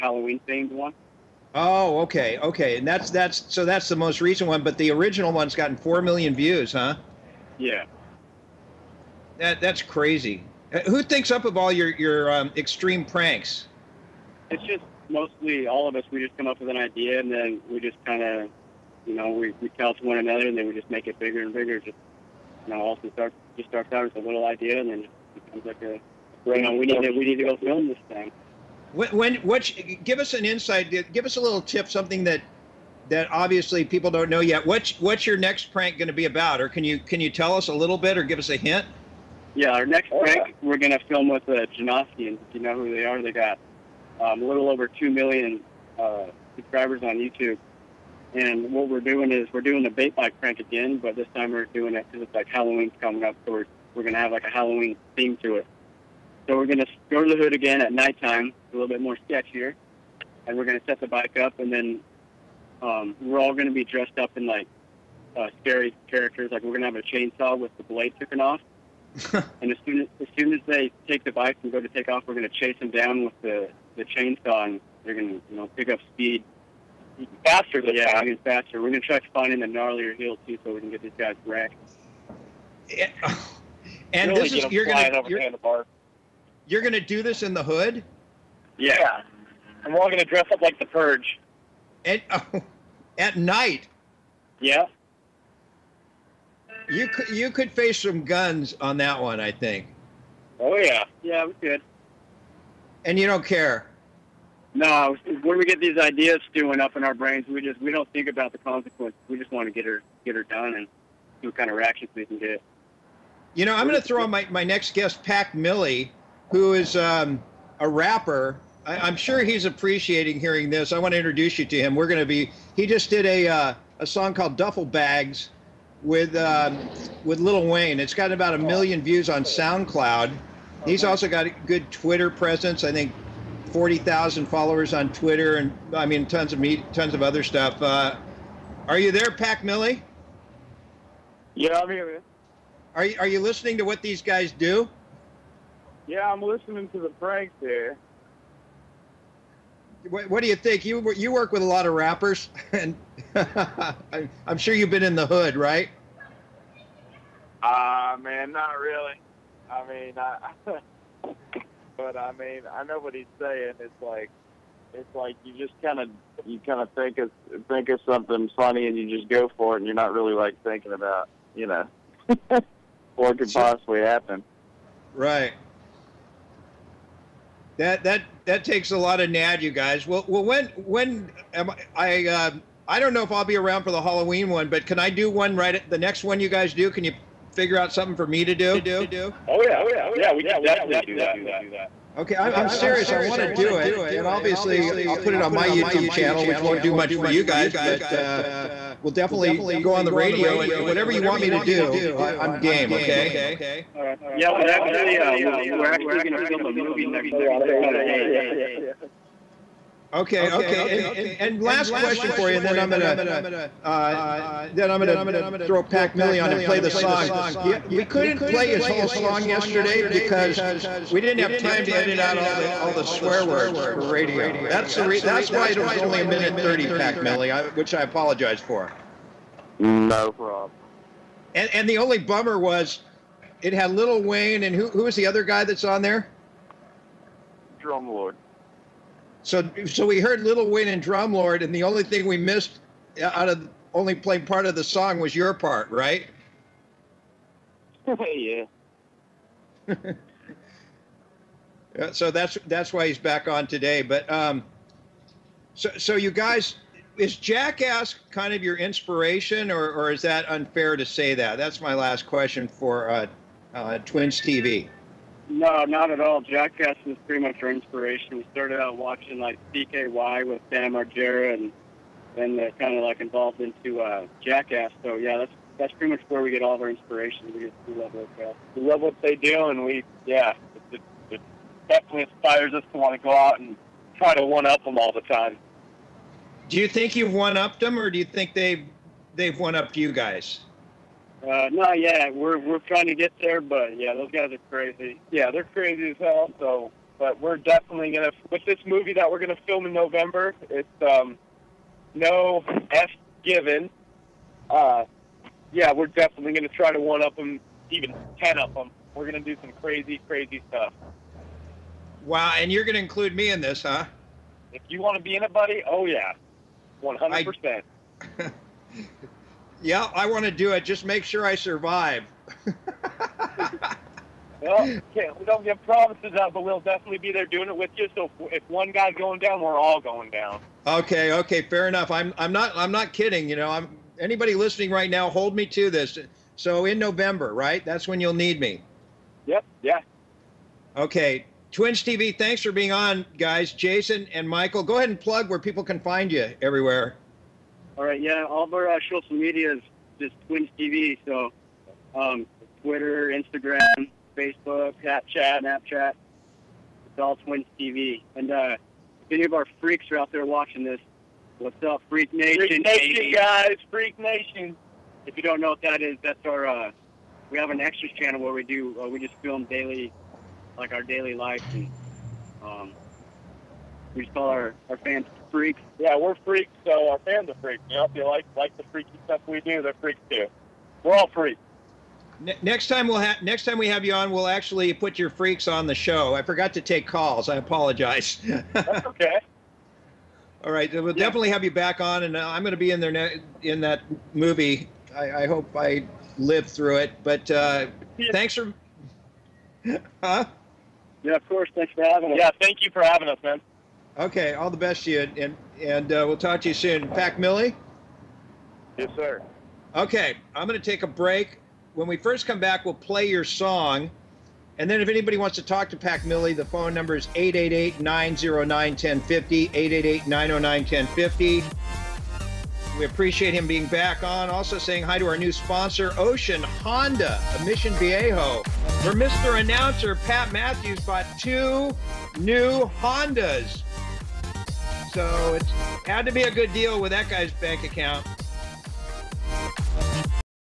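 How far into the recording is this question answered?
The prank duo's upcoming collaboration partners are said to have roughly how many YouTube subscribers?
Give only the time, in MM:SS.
00:44.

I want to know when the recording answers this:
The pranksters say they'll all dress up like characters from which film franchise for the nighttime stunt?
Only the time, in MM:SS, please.
01:30.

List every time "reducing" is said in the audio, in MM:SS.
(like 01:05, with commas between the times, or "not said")
not said.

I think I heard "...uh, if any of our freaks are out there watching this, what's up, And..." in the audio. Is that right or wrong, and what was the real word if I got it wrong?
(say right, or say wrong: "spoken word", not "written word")
wrong: "Freak", not "And".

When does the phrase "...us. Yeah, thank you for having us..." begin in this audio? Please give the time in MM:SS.
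06:42.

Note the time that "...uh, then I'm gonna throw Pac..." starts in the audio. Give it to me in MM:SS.
03:33.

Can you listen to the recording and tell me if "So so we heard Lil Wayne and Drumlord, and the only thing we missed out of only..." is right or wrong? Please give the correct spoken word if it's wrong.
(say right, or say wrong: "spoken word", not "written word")
right.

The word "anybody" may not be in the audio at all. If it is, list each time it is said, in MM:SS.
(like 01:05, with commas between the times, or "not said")
05:34, 06:55.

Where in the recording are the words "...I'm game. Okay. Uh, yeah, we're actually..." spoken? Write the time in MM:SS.
03:22.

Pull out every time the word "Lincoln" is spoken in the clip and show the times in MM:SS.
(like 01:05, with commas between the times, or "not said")
not said.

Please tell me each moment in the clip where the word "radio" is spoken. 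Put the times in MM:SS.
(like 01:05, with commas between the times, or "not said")
03:20, 03:44.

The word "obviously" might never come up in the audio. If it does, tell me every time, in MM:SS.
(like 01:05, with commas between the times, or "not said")
00:33, 03:14.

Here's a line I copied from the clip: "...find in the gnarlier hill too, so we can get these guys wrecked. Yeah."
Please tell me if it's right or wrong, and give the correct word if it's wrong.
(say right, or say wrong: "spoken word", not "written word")
right.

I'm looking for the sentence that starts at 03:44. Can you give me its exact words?
That's the re- that's why it was only a minute thirty, Pac Millie, which I apologize for.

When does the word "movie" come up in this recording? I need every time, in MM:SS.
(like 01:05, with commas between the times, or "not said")
03:26, 04:58, 06:34.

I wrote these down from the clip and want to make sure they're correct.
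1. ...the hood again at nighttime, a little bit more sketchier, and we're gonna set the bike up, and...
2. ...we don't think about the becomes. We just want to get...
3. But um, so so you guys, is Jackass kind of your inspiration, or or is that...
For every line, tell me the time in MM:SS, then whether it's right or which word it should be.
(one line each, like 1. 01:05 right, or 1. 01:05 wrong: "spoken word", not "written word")
1. 00:57 right
2. 01:47 wrong: "consequences", not "becomes"
3. 04:14 right.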